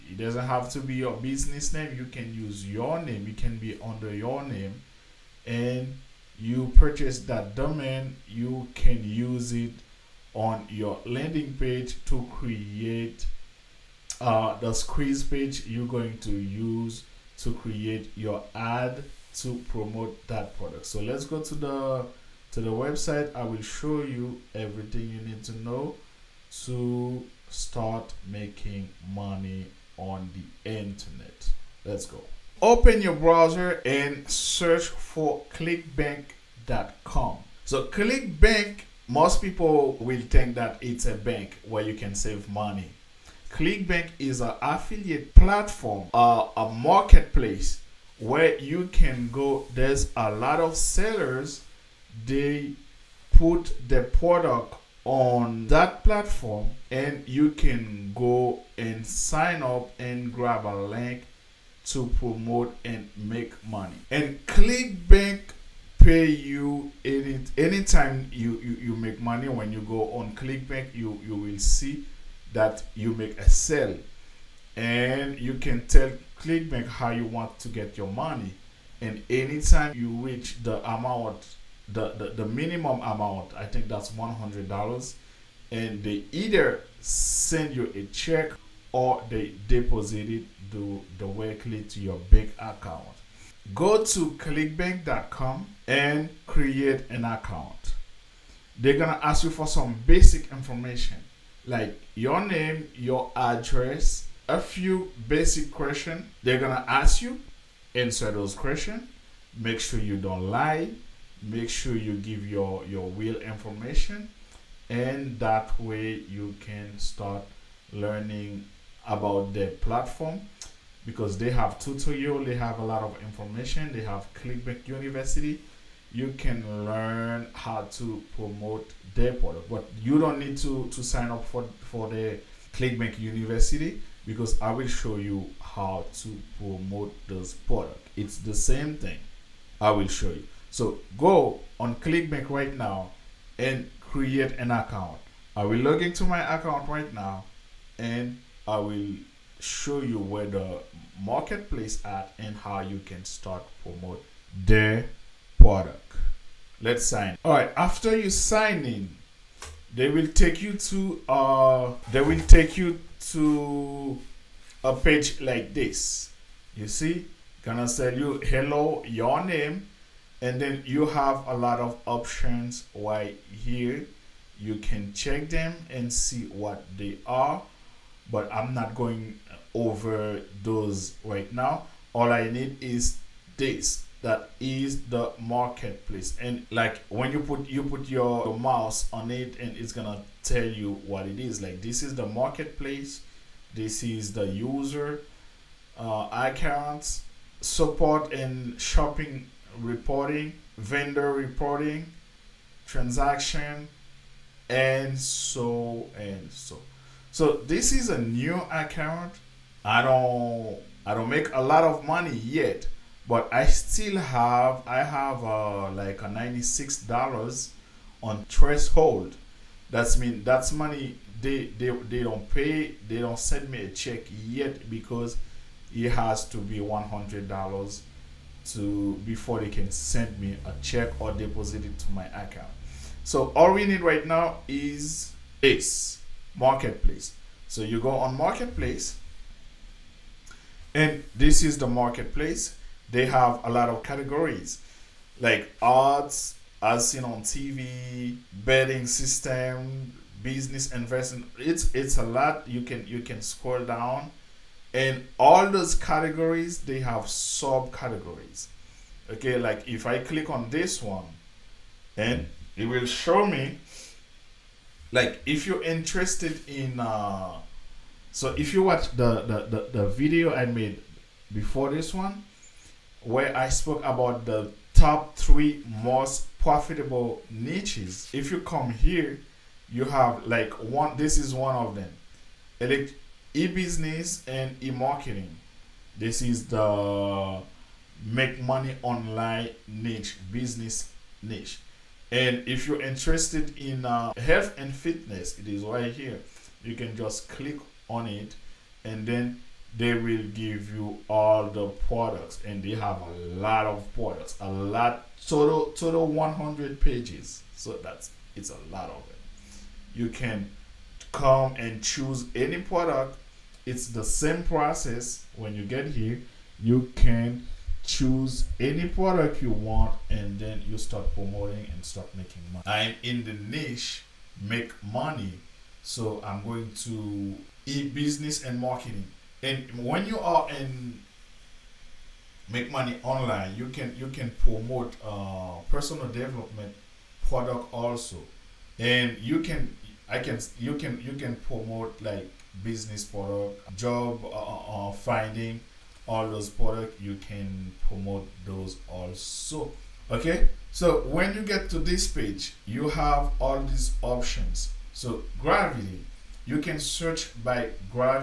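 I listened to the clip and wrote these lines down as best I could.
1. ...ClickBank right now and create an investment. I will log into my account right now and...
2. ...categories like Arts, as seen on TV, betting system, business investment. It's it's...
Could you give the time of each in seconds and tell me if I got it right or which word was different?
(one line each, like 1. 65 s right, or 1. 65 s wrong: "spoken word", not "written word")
1. 141 s wrong: "account", not "investment"
2. 244 s right.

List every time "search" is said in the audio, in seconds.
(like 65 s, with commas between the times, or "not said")
34 s, 356 s.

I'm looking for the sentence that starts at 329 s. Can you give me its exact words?
And when you are in make money online, you can you can promote uh, personal development product also.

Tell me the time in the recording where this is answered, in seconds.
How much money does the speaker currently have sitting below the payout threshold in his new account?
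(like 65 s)
216 s.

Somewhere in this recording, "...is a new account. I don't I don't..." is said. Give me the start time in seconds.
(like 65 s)
207 s.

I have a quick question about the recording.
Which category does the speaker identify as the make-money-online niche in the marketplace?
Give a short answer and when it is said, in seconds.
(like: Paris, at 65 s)
E-business and e-marketing, at 283 s.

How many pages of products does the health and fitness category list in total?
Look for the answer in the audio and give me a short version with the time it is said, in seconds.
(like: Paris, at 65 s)
100, at 306 s.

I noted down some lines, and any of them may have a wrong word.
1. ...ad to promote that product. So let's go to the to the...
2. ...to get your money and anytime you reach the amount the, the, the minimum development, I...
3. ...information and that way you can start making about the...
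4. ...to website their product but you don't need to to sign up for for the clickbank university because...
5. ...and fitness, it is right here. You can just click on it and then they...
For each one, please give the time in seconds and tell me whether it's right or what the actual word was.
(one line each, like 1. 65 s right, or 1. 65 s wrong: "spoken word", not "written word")
1. 18 s right
2. 77 s wrong: "amount", not "development"
3. 113 s wrong: "learning", not "making"
4. 127 s wrong: "promote", not "website"
5. 294 s right.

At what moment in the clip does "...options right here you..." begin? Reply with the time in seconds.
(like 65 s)
172 s.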